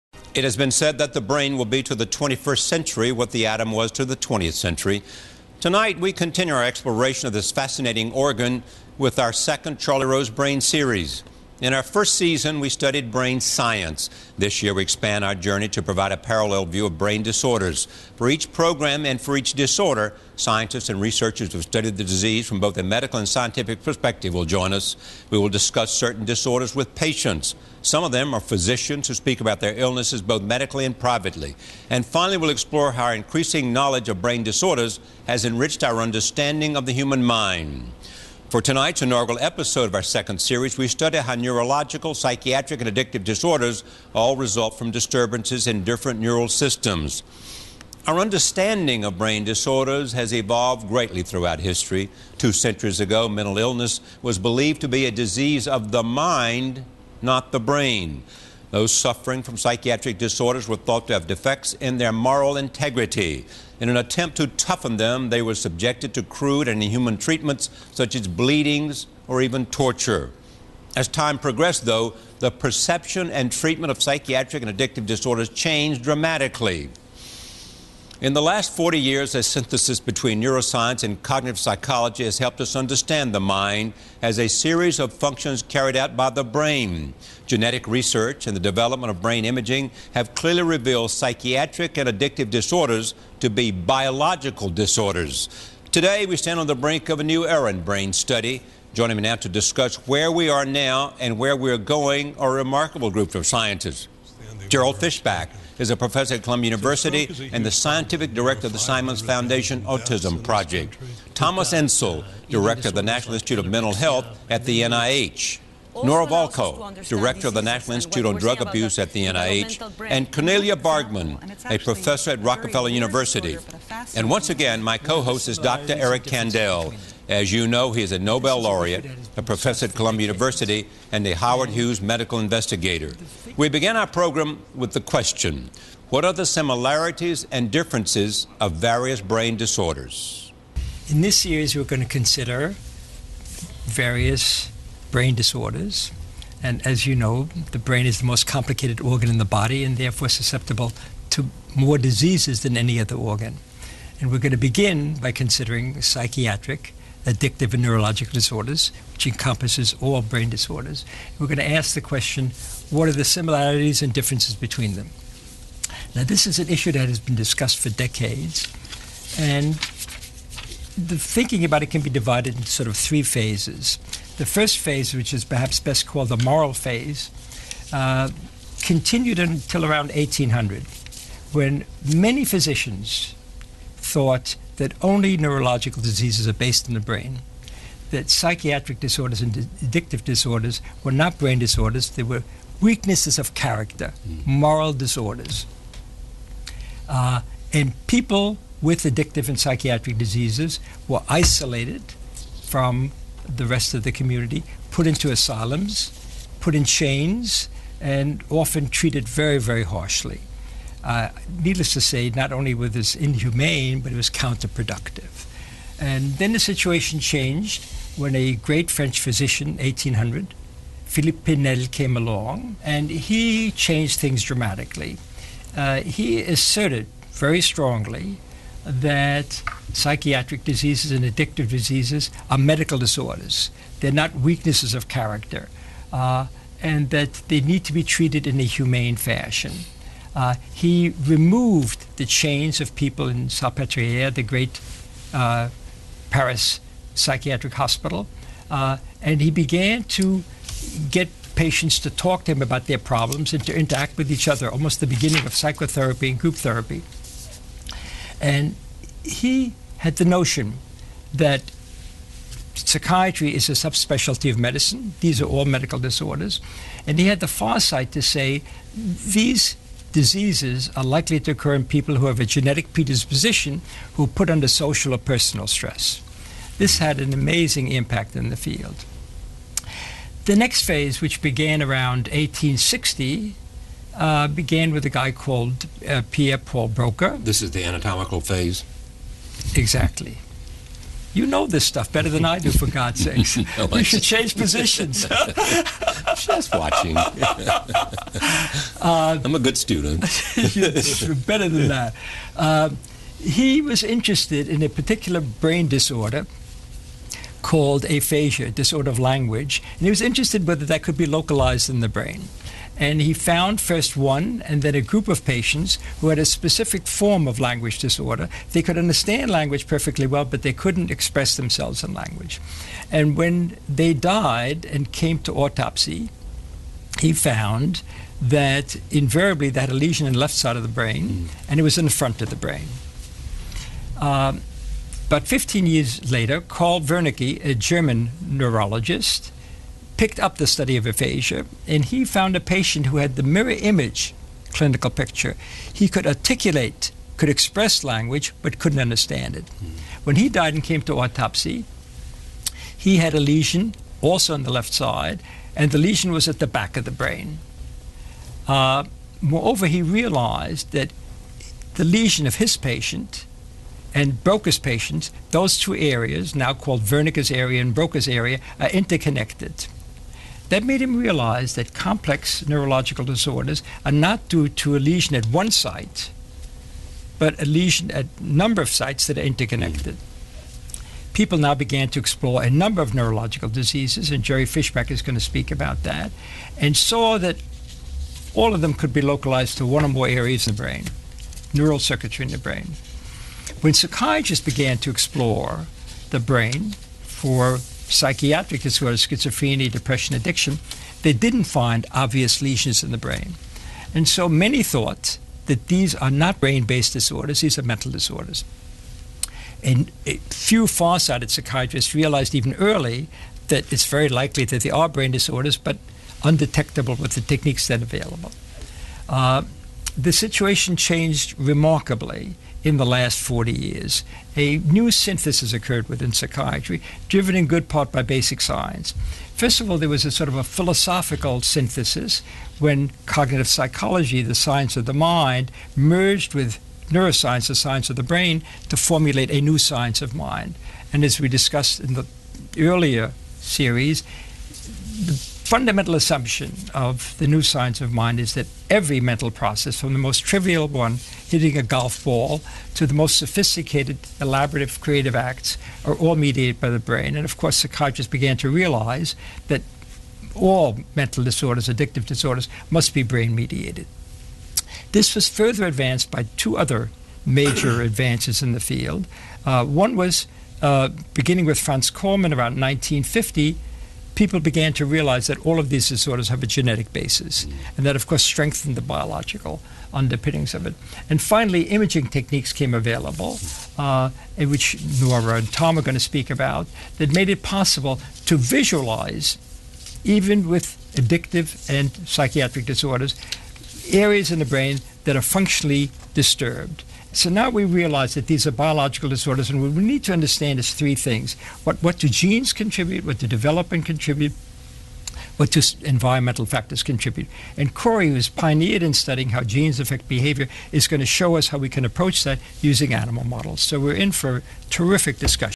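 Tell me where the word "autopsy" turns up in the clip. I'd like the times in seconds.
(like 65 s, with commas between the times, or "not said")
325 s, 351 s.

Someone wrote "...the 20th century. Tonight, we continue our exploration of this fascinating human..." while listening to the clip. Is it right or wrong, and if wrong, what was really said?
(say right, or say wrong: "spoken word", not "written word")
wrong: "organ", not "human".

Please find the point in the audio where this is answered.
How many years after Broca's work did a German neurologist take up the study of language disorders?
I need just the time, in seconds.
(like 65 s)
335 s.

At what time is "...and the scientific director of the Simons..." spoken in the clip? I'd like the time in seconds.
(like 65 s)
107 s.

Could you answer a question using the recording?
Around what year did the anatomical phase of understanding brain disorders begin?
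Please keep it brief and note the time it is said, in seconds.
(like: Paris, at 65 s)
1860, at 282 s.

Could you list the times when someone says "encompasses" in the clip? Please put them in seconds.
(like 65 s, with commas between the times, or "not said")
159 s.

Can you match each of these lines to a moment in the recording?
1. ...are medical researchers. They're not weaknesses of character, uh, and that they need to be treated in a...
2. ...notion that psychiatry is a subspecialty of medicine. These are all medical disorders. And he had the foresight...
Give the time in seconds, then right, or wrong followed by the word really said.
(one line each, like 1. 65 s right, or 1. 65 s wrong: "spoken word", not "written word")
1. 232 s wrong: "disorders", not "researchers"
2. 260 s right.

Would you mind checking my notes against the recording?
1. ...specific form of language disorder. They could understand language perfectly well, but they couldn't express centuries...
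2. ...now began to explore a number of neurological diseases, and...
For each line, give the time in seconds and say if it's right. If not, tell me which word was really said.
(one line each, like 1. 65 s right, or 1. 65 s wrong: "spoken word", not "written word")
1. 316 s wrong: "themselves", not "centuries"
2. 381 s right.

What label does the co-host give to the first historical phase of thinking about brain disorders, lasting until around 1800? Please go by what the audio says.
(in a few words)
moral phase.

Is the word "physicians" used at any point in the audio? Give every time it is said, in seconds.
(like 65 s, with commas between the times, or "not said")
28 s, 182 s, 219 s.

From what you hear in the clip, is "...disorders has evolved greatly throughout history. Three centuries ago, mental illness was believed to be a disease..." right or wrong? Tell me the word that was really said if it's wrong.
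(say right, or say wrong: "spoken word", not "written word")
wrong: "Two", not "Three".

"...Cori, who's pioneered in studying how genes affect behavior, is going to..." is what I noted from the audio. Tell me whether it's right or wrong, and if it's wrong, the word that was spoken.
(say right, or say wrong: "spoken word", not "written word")
right.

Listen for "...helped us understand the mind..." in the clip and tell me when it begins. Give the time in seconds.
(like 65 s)
82 s.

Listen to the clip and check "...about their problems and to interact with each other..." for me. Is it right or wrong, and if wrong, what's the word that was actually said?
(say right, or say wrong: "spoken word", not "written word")
right.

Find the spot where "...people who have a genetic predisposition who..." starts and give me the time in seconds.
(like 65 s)
271 s.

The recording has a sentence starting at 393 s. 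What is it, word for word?
When psychiatrists began to explore the brain for psychiatric disorders, schizophrenia, depression, addiction, they didn't find obvious lesions in the brain.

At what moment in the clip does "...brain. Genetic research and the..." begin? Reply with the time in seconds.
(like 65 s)
86 s.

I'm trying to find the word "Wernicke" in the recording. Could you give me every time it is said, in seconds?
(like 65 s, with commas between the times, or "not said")
337 s, 367 s.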